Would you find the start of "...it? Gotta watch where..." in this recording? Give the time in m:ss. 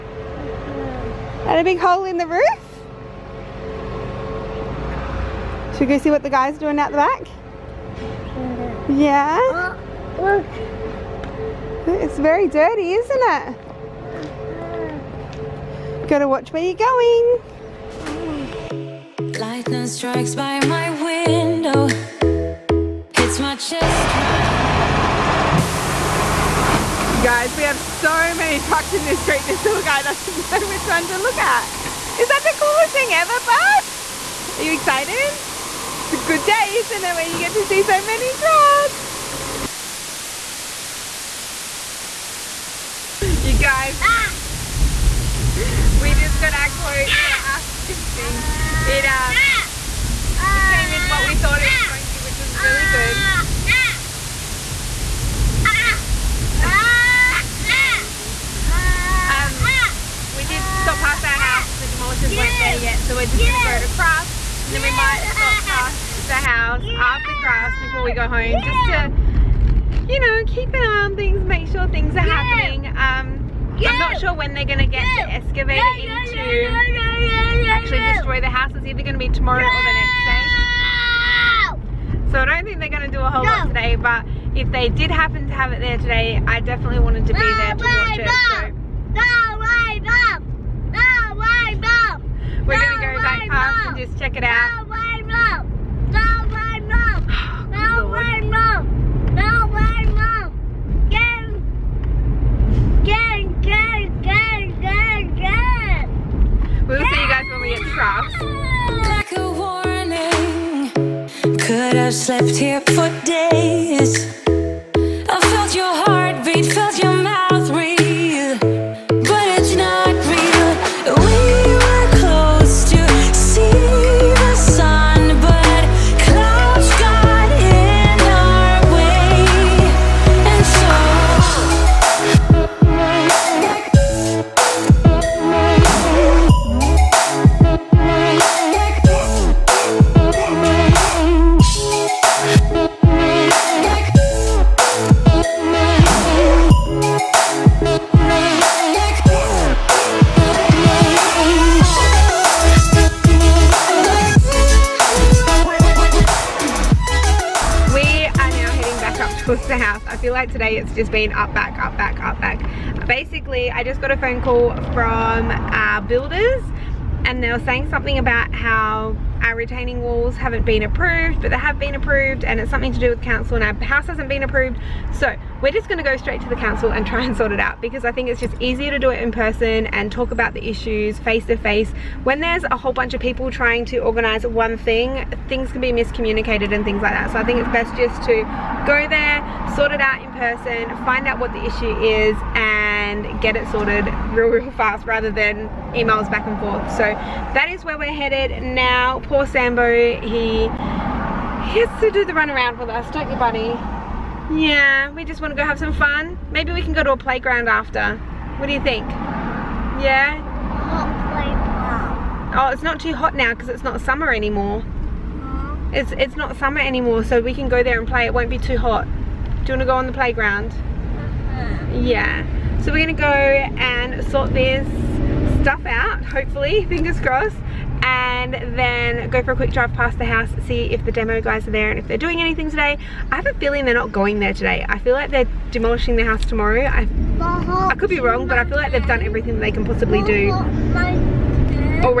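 0:13.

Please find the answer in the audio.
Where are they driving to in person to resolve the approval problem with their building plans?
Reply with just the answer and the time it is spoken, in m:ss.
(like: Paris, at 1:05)
the council, at 2:56.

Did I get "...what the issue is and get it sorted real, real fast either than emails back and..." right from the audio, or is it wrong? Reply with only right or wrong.
wrong.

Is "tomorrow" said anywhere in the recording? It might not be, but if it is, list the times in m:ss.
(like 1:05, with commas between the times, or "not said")
1:19, 3:56.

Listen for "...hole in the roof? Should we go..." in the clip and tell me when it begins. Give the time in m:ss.
0:01.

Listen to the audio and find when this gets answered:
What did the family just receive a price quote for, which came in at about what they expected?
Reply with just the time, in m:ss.
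0:47.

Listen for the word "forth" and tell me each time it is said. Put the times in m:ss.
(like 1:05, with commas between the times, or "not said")
3:16.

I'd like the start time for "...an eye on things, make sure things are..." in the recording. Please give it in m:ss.
1:10.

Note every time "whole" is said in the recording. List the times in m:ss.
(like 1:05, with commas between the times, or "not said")
1:23, 3:02.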